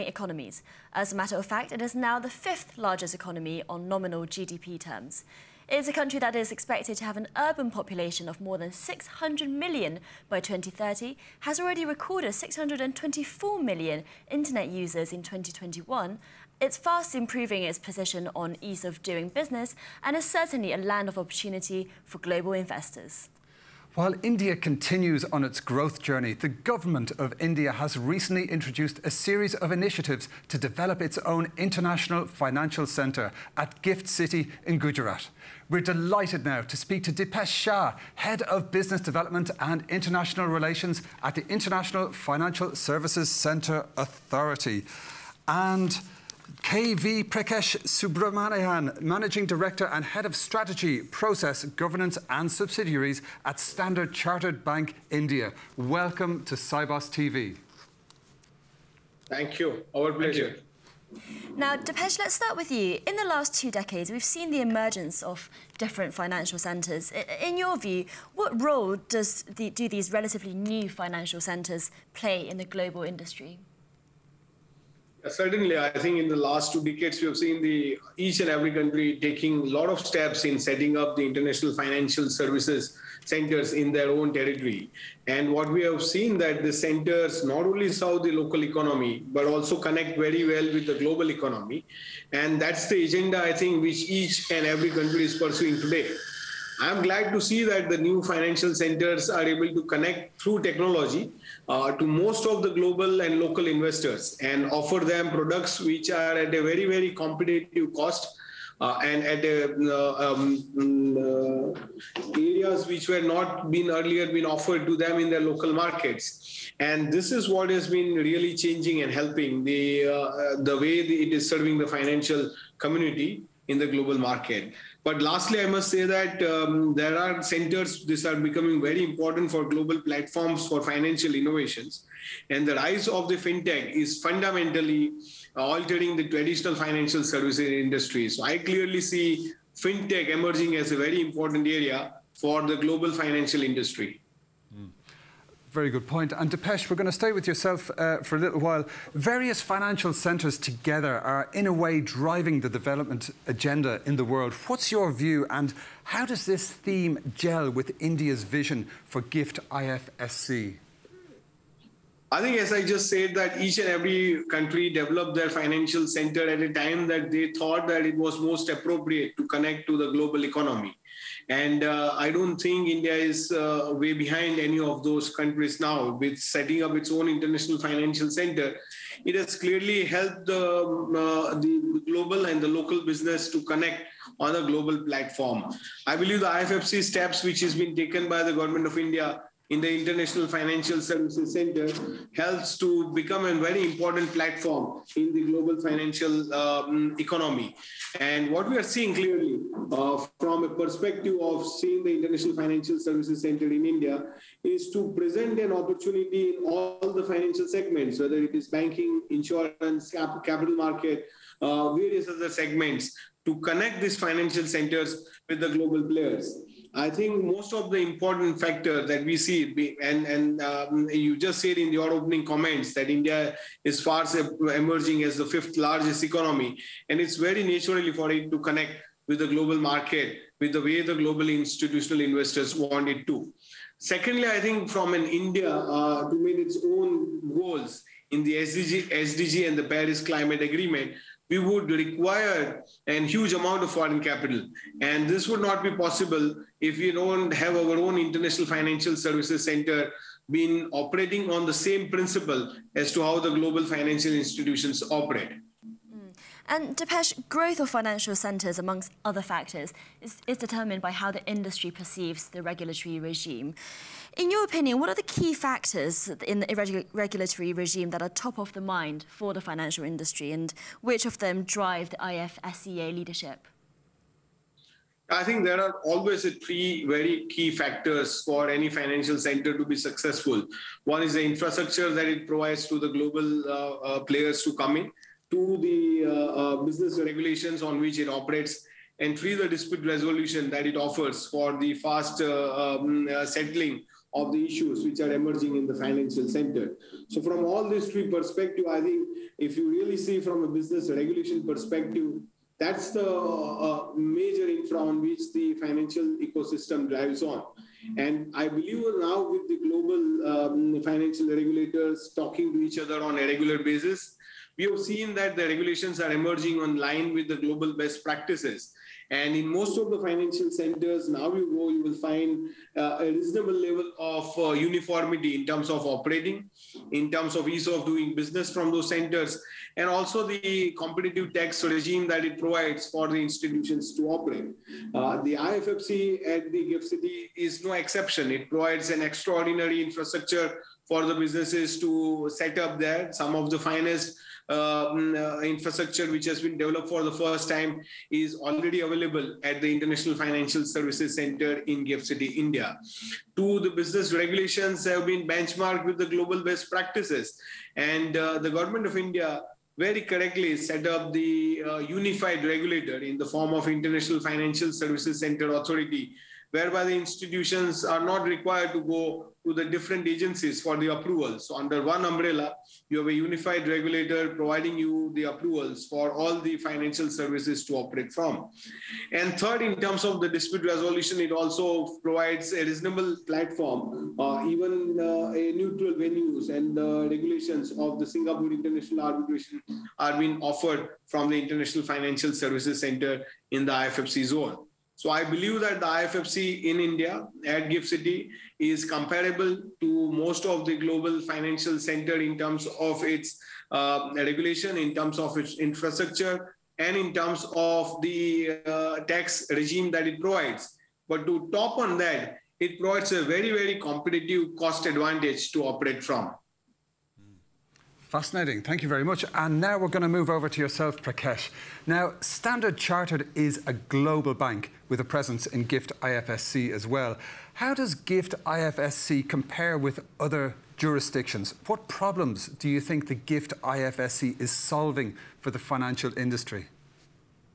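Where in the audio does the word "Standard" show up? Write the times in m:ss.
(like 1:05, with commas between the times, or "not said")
0:53, 7:02.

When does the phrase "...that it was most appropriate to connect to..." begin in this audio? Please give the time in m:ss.
2:47.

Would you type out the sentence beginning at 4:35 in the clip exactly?
I think there are always three very key factors for any financial center to be successful.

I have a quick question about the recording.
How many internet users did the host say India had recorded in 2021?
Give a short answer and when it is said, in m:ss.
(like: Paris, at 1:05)
624 million, at 0:12.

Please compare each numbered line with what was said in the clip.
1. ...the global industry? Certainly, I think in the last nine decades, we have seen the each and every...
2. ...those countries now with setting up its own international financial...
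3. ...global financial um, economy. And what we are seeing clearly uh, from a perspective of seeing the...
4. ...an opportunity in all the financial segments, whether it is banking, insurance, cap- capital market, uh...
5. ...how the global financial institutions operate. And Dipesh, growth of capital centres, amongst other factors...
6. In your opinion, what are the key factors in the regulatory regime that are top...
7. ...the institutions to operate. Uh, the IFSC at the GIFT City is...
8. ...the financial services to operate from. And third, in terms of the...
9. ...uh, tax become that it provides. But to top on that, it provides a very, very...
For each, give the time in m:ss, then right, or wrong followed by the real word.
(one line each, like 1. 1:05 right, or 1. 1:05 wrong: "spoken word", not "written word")
1. 1:12 wrong: "two", not "nine"
2. 2:55 right
3. 3:15 right
4. 3:25 right
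5. 4:13 wrong: "financial", not "capital"
6. 4:24 right
7. 5:33 right
8. 6:16 right
9. 6:48 wrong: "regime", not "become".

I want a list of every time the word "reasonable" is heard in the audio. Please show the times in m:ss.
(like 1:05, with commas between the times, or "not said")
5:23, 6:22.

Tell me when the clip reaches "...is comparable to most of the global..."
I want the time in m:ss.
6:38.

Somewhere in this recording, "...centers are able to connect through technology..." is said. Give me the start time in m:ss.
1:38.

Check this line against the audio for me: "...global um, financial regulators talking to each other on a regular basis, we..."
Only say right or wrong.
right.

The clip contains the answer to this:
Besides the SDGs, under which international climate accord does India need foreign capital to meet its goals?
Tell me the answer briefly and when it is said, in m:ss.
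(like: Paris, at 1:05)
Paris Climate Agreement, at 3:59.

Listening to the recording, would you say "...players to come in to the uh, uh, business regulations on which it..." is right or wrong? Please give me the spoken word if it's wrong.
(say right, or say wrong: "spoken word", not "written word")
right.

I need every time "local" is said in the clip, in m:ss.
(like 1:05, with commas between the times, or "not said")
1:28, 1:43, 1:55, 3:02.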